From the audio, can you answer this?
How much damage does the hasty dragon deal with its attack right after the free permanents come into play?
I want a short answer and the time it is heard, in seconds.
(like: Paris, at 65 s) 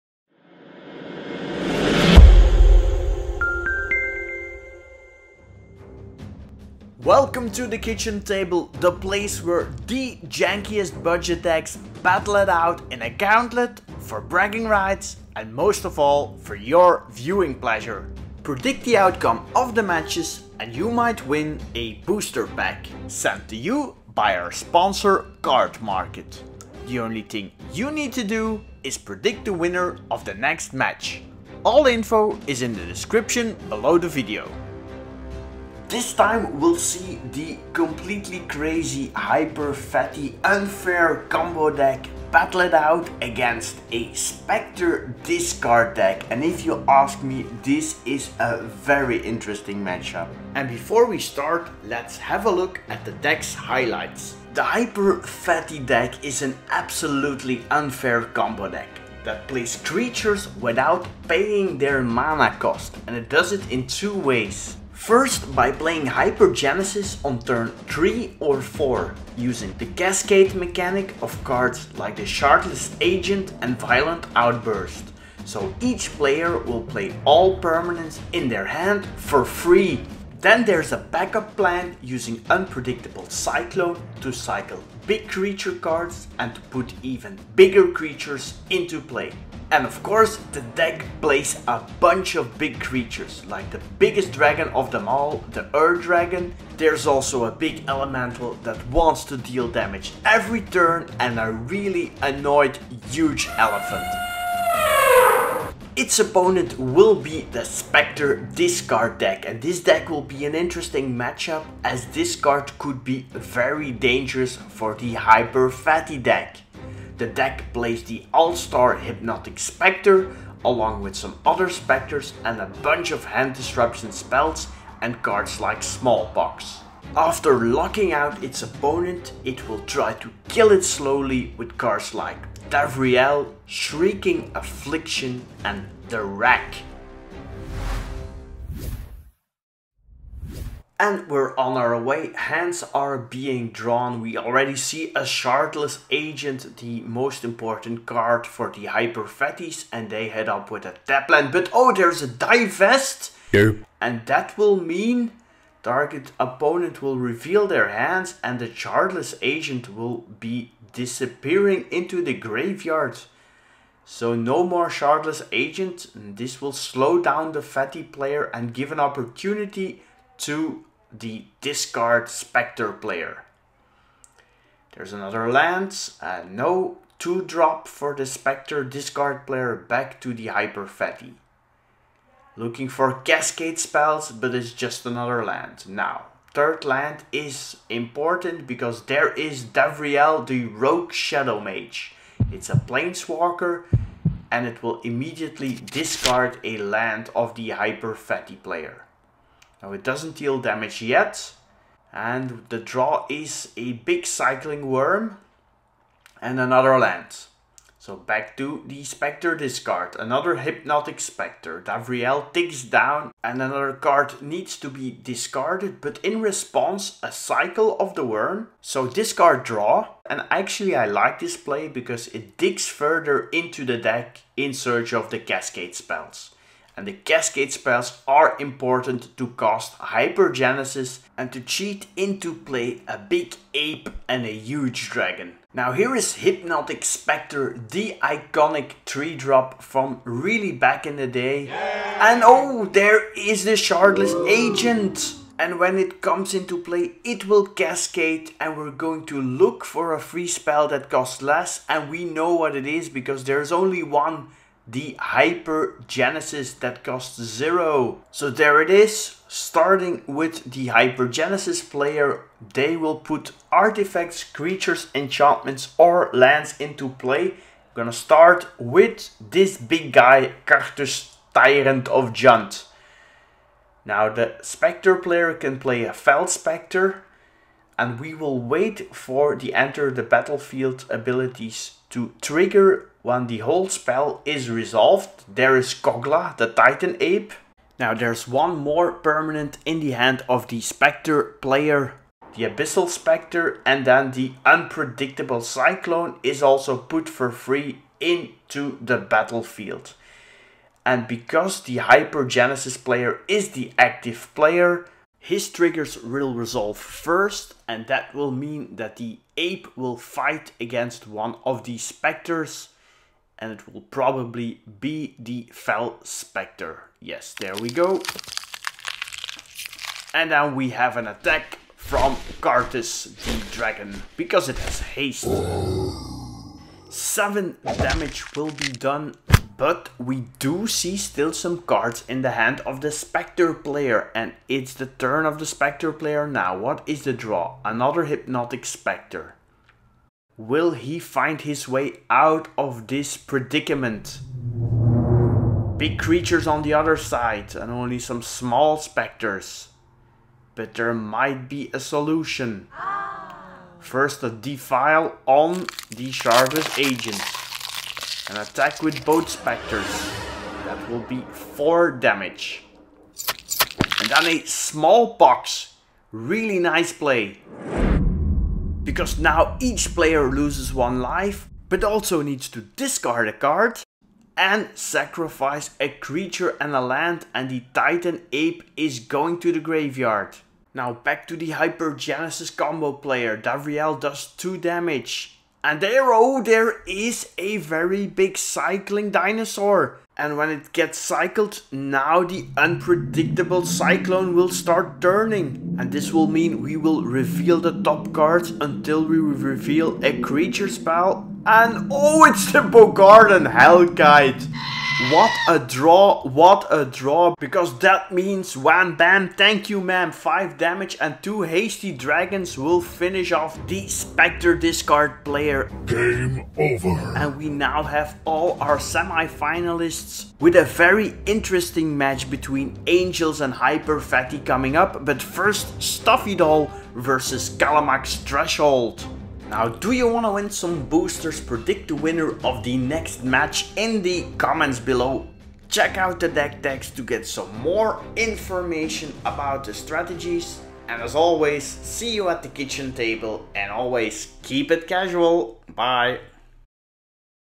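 7, at 327 s.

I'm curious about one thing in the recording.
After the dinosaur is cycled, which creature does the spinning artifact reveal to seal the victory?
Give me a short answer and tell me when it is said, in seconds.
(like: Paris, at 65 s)
Bogardan Hellkite, at 402 s.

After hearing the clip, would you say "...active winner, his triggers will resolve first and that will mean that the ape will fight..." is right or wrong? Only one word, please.
wrong.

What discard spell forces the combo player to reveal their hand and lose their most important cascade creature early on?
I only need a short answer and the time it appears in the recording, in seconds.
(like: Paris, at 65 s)
Divest, at 152 s.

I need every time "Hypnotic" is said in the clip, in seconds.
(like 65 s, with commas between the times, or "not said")
118 s, 210 s, 236 s, 338 s.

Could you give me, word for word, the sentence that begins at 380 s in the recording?
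Now back to the Hypergenesis combo player, Davriel does 2 damage and there, oh, there is a very big cycling dinosaur.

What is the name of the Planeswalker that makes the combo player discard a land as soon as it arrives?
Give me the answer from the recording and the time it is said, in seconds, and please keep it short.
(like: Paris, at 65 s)
Davriel the Rogue Shadow Mage, at 189 s.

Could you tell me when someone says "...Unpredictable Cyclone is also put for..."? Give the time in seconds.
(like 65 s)
294 s.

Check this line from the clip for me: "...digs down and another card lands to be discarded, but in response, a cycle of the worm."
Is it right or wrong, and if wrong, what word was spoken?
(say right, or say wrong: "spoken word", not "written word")
wrong: "needs", not "lands".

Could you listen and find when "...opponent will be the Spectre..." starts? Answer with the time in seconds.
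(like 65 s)
106 s.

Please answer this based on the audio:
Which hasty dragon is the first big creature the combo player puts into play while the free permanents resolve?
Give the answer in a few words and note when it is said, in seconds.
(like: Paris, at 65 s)
Karrthus, Tyrant of Jund, at 270 s.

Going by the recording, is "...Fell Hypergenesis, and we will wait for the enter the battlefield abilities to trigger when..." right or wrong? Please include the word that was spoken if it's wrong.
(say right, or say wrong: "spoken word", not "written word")
wrong: "Spectre", not "Hypergenesis".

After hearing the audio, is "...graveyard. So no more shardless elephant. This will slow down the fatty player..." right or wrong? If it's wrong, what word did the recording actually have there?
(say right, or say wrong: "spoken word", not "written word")
wrong: "agent", not "elephant".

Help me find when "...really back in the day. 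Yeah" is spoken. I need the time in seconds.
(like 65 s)
240 s.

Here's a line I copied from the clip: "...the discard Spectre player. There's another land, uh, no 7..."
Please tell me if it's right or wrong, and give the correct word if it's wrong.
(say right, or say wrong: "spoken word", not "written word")
wrong: "2", not "7".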